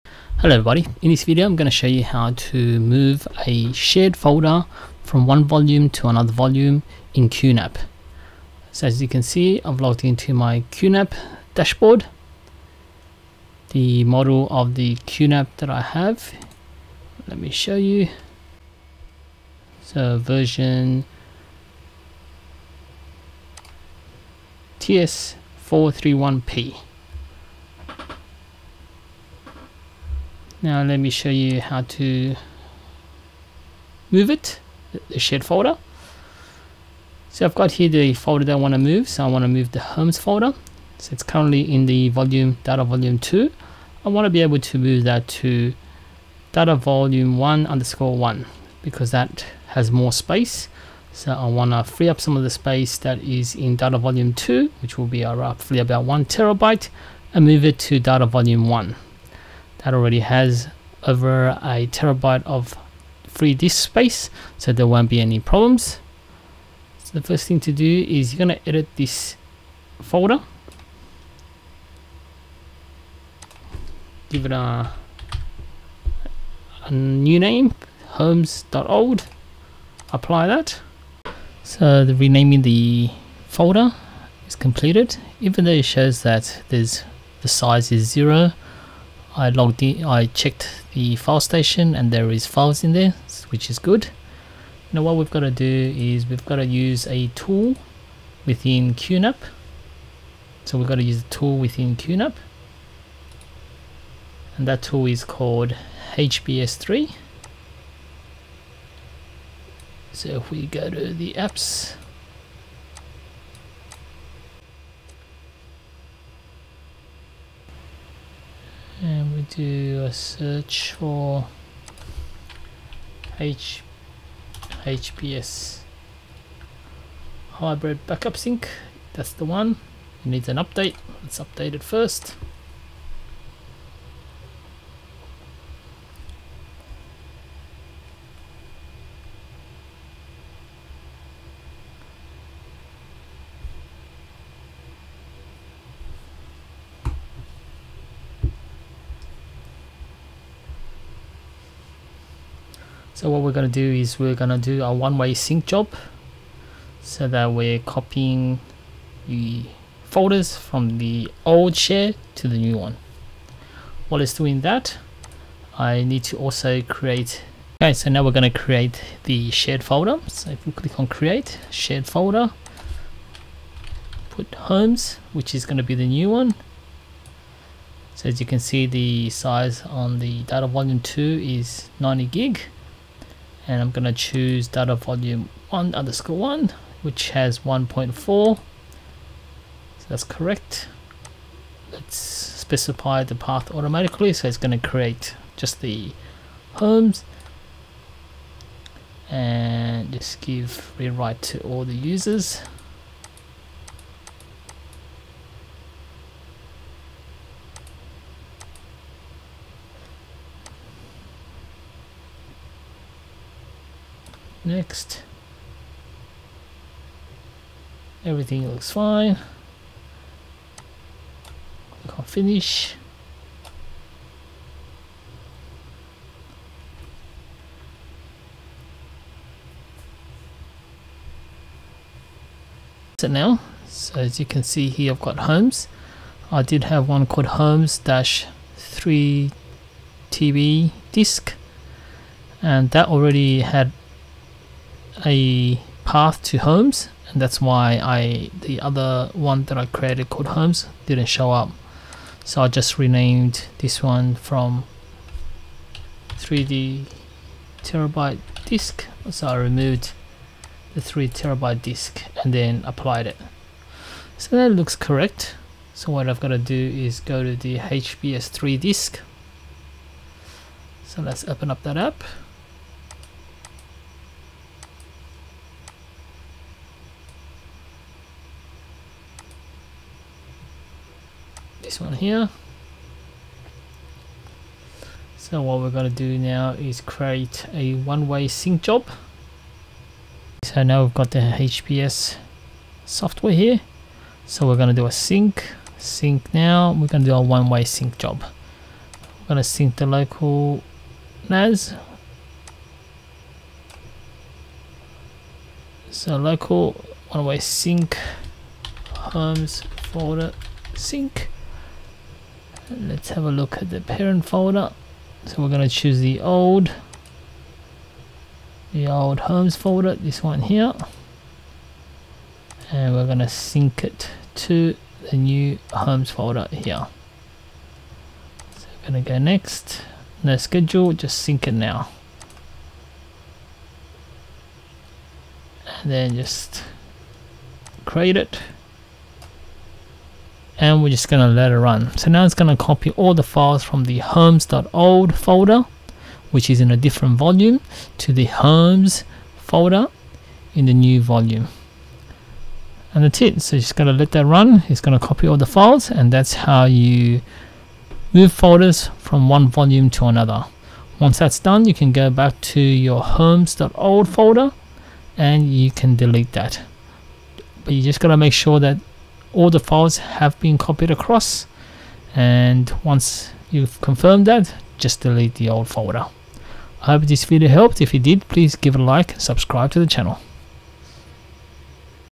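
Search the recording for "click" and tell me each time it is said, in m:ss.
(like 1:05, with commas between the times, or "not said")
2:50, 3:42.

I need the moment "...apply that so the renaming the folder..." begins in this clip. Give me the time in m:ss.
1:20.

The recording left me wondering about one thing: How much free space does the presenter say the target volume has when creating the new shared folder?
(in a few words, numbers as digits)
1.4.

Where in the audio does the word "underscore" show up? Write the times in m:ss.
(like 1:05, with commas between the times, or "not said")
0:47, 3:05.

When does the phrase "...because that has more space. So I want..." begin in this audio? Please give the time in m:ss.
0:48.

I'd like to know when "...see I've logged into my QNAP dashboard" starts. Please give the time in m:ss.
0:09.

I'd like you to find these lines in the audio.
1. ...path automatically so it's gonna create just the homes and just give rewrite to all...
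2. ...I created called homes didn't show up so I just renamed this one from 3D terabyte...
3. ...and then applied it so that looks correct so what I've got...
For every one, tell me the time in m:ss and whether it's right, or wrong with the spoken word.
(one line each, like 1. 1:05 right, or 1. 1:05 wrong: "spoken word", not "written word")
1. 3:13 right
2. 4:09 right
3. 4:22 right.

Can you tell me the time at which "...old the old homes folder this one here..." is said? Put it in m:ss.
5:16.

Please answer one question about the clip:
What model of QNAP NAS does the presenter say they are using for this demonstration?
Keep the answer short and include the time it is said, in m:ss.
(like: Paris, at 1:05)
TS431P, at 0:24.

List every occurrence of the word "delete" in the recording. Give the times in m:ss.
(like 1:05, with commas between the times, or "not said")
6:06, 6:15.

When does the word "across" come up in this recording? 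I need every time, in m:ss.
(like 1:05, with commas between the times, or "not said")
6:11.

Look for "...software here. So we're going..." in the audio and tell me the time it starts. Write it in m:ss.
4:53.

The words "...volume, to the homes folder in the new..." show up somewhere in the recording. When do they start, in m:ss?
5:47.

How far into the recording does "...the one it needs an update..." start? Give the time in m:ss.
2:09.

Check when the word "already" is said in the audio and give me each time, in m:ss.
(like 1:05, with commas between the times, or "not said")
0:59, 4:03.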